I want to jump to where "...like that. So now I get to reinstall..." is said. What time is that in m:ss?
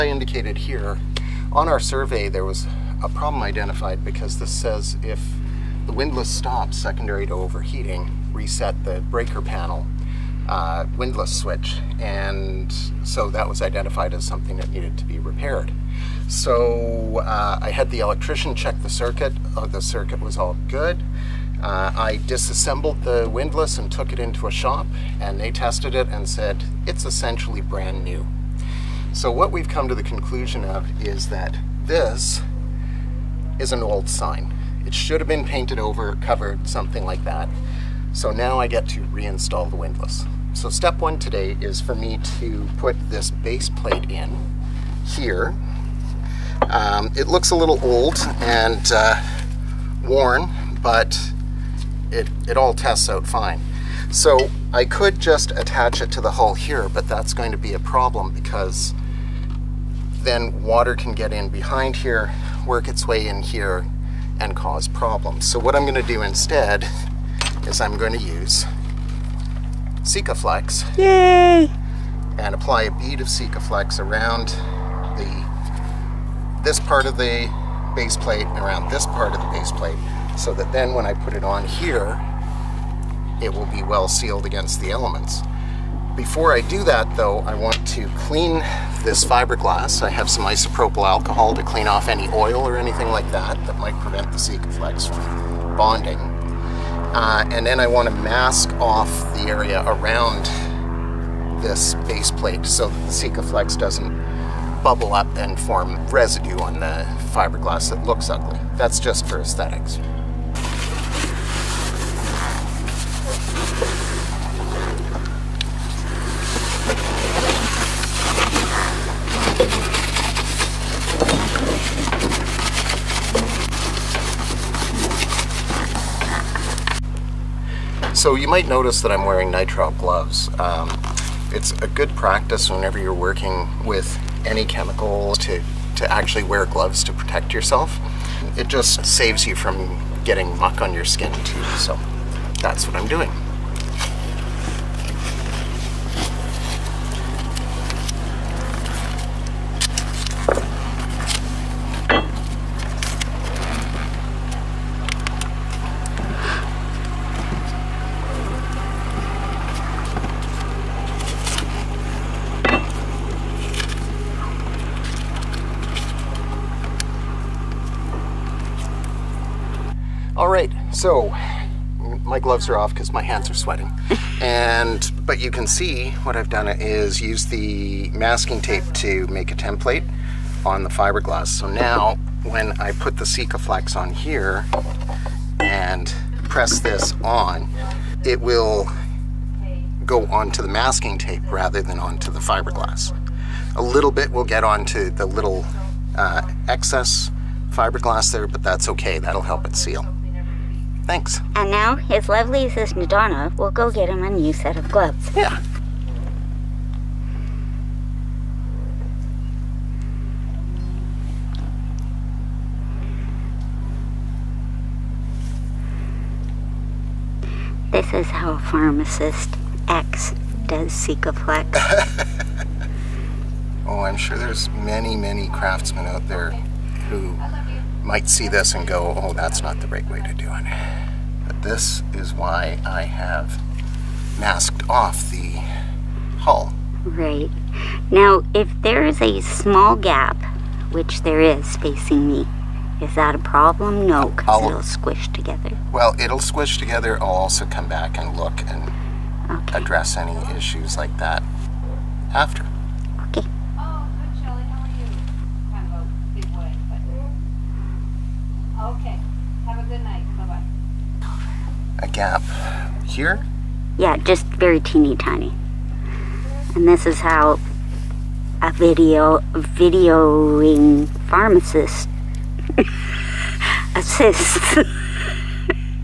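0:37.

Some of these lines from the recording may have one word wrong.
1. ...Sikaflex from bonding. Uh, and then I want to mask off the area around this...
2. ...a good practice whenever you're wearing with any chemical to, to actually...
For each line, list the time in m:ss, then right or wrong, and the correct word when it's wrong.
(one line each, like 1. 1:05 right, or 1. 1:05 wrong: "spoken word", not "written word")
1. 1:34 right
2. 2:11 wrong: "working", not "wearing".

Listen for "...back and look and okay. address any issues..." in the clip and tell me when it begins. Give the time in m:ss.
4:07.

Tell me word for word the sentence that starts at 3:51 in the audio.
But this is why I have masked off the hull.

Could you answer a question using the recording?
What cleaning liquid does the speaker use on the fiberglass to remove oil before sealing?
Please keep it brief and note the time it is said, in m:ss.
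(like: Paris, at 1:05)
isopropyl alcohol, at 1:30.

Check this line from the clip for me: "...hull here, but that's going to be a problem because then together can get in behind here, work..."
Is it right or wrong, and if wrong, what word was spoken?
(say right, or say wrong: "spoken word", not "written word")
wrong: "water", not "together".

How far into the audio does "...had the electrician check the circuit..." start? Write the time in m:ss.
0:17.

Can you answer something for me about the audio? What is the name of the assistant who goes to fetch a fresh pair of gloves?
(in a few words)
Donna.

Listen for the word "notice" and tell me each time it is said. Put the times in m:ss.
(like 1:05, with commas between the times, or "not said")
2:08.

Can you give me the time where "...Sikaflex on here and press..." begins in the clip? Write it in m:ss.
3:03.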